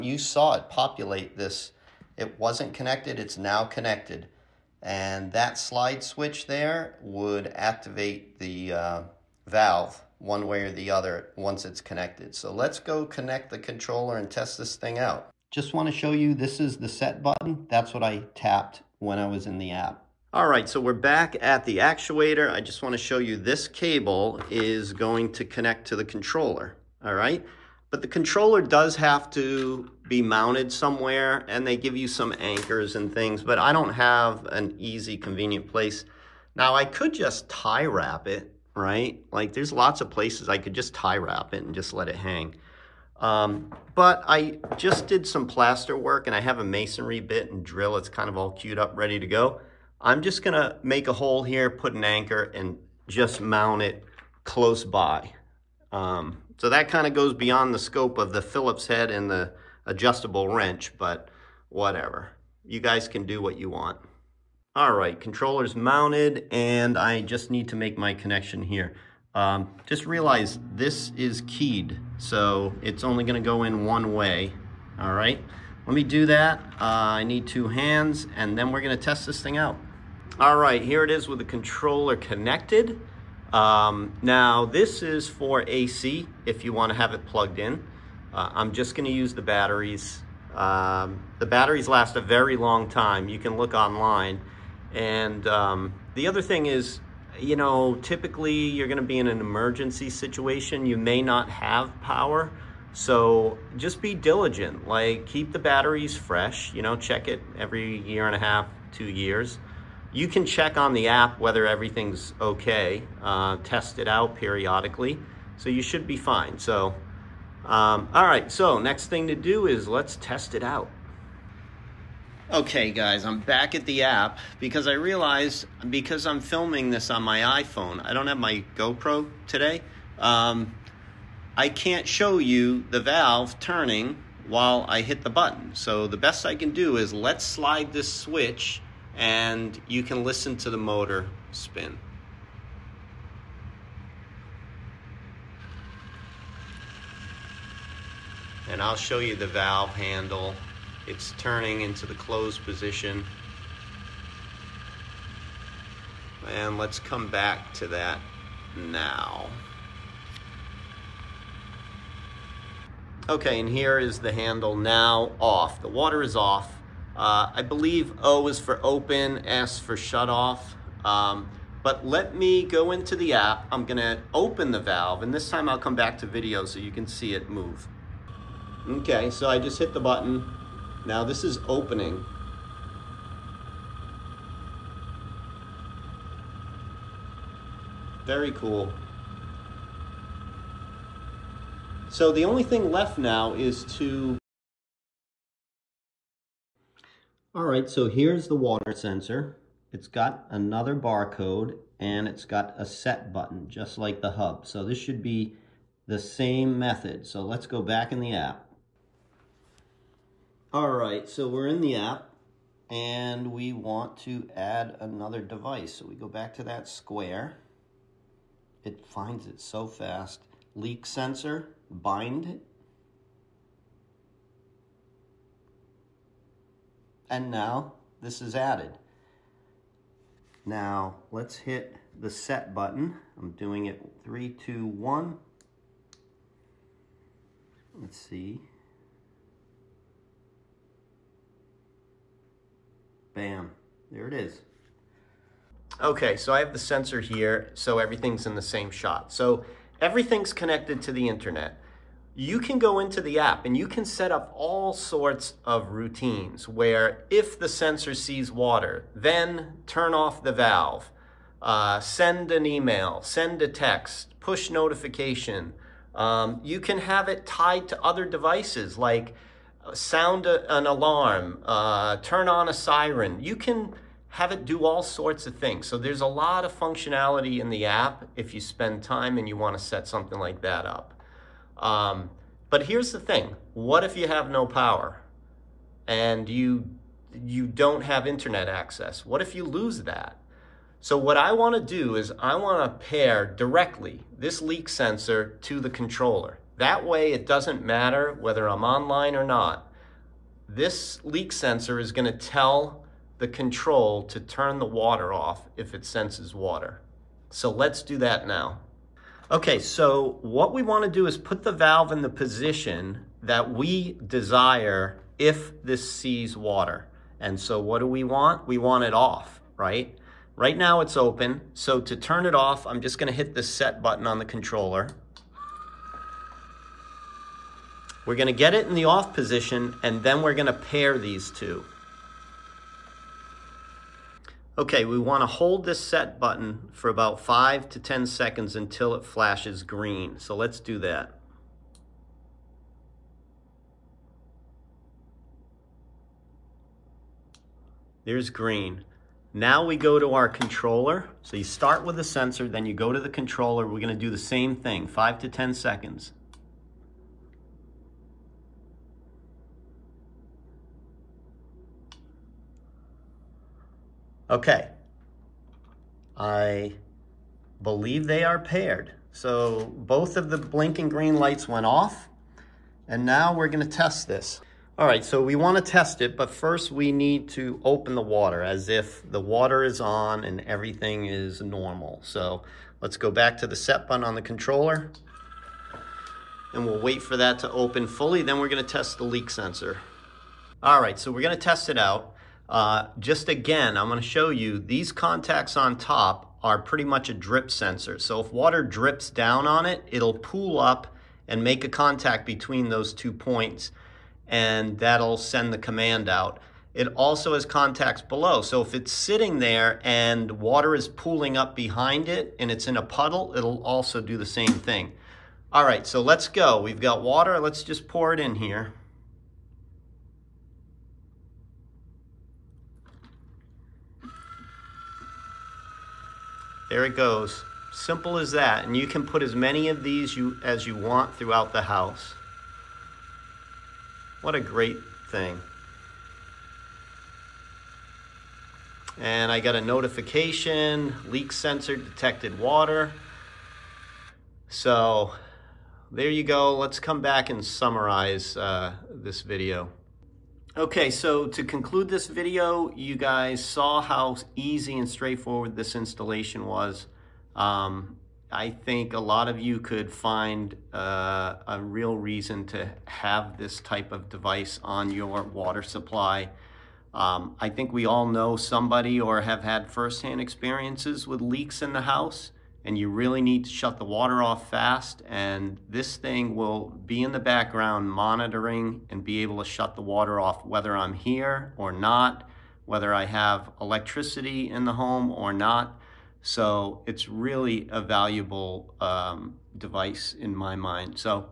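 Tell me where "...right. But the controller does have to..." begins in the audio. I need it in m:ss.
0:27.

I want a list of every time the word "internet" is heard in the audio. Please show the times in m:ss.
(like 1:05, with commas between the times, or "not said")
4:11, 4:48.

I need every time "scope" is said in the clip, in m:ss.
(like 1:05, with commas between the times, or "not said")
0:57.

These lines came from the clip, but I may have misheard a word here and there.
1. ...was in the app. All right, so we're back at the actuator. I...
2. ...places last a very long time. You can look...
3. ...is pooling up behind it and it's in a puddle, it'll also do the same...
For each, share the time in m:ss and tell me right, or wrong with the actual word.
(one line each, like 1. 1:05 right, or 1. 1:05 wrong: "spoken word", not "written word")
1. 0:19 right
2. 1:31 wrong: "batteries", not "places"
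3. 6:50 right.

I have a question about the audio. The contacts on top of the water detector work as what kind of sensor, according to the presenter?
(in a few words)
drip sensor.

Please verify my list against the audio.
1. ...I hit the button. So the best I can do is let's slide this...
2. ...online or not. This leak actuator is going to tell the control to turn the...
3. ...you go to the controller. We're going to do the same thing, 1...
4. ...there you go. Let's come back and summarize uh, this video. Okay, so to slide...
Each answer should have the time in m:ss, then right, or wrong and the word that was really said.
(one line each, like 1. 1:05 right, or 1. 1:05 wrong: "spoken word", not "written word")
1. 2:14 right
2. 4:58 wrong: "sensor", not "actuator"
3. 5:52 wrong: "5", not "1"
4. 7:26 wrong: "conclude", not "slide".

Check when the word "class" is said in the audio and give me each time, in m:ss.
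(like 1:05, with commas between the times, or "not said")
not said.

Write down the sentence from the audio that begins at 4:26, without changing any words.
Um, you can have it tied to other devices like uh, sound a, an alarm, uh, turn on a siren.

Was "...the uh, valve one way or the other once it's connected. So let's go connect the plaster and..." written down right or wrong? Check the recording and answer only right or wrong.
wrong.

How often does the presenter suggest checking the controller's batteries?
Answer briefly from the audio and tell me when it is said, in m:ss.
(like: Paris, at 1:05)
every year and a half, two years, at 1:47.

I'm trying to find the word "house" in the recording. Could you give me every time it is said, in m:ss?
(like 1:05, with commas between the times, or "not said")
7:11, 7:52.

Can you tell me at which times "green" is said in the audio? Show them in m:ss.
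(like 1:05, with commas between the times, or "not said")
5:39, 5:48, 6:11.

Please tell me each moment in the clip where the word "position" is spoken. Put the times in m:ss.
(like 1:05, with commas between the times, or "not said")
2:32, 5:12, 5:29.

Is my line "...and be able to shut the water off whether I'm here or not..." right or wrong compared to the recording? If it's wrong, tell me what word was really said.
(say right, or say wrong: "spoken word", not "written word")
right.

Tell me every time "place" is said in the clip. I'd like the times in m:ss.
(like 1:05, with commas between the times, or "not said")
0:35, 0:40.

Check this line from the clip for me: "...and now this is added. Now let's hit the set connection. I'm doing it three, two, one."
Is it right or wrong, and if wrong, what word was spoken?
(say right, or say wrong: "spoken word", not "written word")
wrong: "button", not "connection".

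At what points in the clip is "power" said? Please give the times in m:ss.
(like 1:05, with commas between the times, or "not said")
1:42, 4:44.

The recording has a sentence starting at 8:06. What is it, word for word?
So it's really a valuable um, device in my mind.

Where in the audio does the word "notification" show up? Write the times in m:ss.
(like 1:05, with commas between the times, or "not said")
4:24, 7:19.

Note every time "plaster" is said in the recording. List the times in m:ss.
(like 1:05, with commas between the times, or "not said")
0:45.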